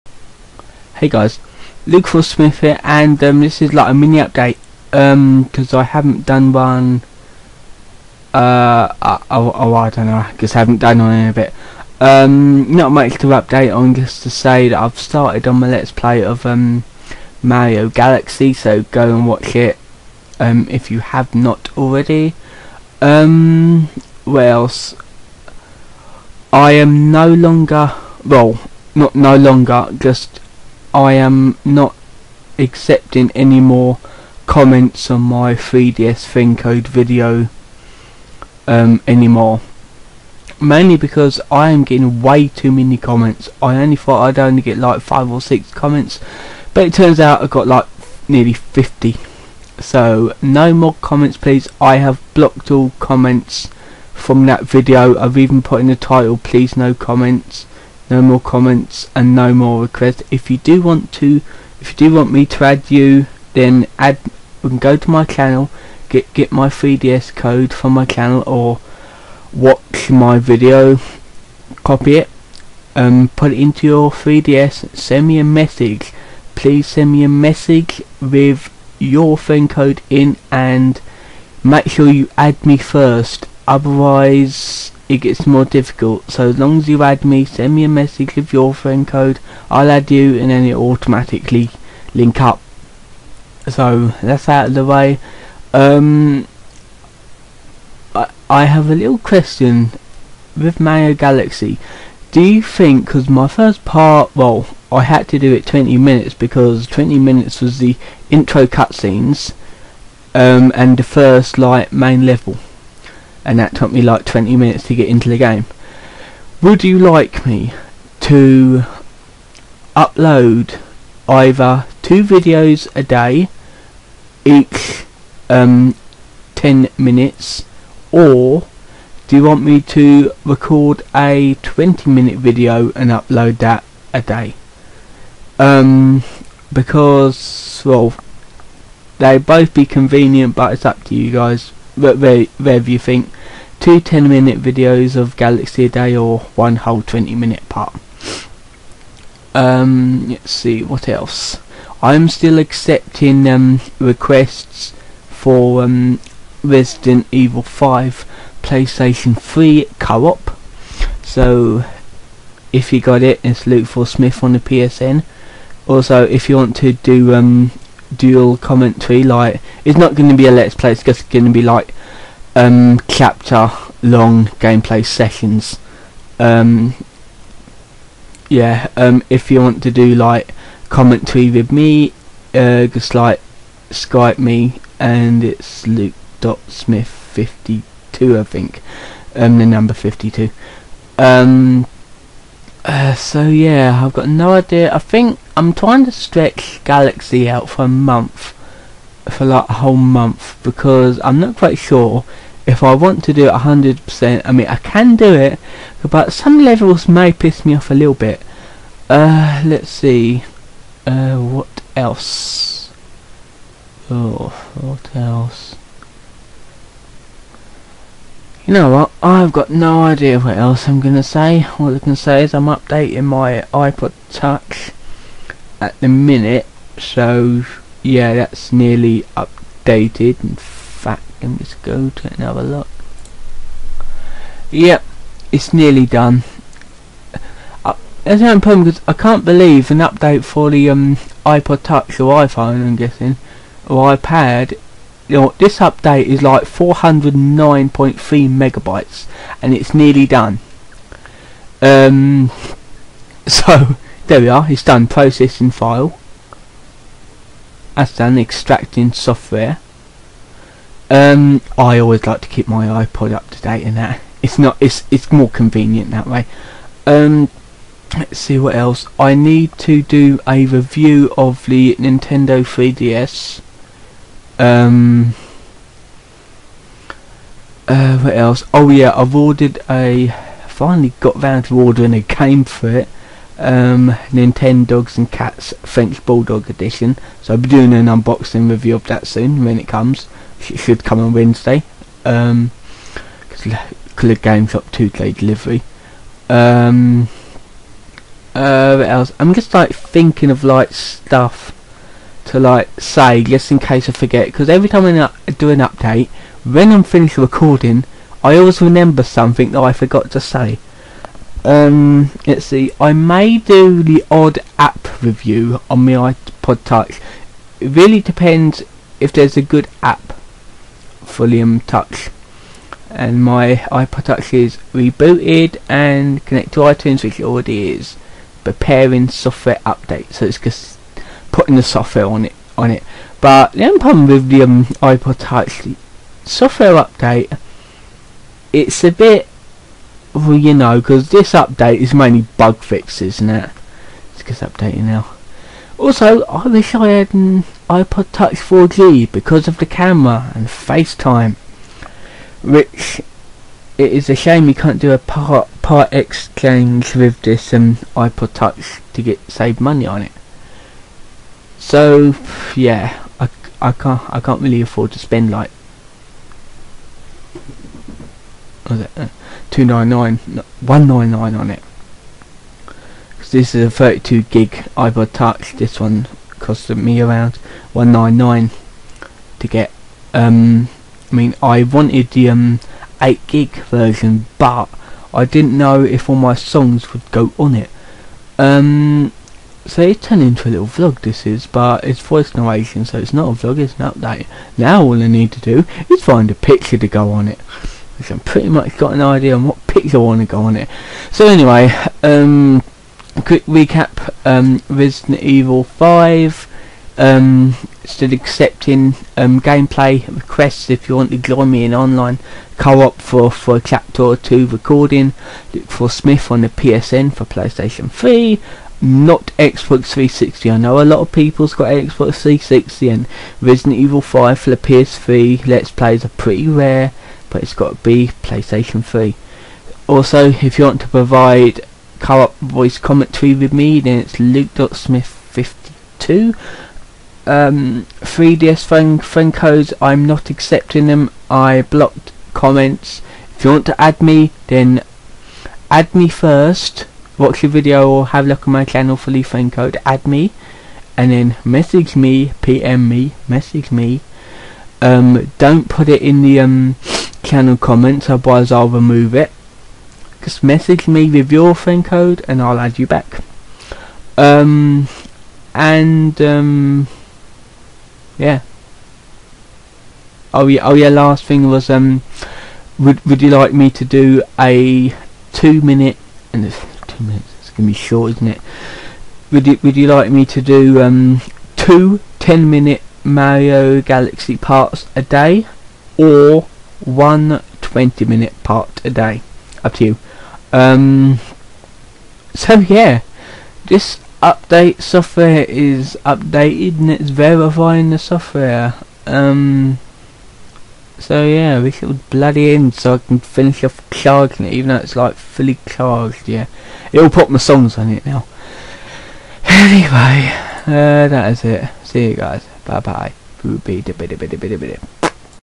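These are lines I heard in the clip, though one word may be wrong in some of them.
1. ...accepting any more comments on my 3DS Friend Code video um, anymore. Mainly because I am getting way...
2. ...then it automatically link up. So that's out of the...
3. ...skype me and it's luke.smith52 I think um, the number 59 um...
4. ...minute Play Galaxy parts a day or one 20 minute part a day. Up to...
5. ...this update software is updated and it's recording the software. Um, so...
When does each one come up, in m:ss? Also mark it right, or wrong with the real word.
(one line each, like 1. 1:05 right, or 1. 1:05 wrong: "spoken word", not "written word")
1. 0:32 right
2. 1:30 right
3. 3:03 wrong: "52", not "59"
4. 8:02 wrong: "Mario", not "Play"
5. 8:13 wrong: "verifying", not "recording".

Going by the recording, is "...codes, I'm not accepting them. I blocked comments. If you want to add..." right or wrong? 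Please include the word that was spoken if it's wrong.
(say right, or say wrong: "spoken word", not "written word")
right.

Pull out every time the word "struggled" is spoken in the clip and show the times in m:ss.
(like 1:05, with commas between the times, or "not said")
not said.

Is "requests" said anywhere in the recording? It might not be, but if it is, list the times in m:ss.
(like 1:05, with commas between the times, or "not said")
0:59, 2:33, 6:50.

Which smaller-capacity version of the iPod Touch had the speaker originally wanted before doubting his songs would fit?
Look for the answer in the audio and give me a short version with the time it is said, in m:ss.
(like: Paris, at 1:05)
8 gig, at 6:23.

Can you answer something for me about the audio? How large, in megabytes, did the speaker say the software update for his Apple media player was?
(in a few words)
409.3 megabytes.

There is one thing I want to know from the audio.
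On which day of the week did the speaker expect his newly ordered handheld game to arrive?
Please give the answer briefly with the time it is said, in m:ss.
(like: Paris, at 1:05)
Wednesday, at 4:51.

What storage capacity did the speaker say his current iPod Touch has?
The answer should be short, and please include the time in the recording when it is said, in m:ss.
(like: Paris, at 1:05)
32 gig, at 6:13.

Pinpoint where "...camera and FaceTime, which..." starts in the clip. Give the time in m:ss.
5:49.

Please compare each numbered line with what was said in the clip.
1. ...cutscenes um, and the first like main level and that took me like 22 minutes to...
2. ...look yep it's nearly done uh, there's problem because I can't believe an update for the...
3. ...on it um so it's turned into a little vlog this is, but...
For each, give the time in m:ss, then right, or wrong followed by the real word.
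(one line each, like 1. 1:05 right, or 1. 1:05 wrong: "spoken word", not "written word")
1. 1:48 wrong: "20", not "22"
2. 3:52 right
3. 6:27 right.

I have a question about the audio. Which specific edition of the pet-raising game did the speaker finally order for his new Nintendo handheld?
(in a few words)
French Bulldog Edition.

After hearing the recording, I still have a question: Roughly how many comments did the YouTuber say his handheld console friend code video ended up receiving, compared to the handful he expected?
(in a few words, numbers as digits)
nearly 50.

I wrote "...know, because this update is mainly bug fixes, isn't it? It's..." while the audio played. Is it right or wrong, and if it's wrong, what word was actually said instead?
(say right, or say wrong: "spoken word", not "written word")
right.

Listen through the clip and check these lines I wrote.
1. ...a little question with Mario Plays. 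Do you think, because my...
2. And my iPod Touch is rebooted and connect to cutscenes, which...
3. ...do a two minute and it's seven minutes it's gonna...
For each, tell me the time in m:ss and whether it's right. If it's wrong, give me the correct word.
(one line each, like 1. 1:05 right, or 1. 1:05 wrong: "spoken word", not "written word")
1. 1:38 wrong: "Galaxy", not "Plays"
2. 5:23 wrong: "iTunes", not "cutscenes"
3. 7:54 wrong: "two", not "seven".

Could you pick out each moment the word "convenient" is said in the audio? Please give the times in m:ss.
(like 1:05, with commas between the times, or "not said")
2:19, 4:25.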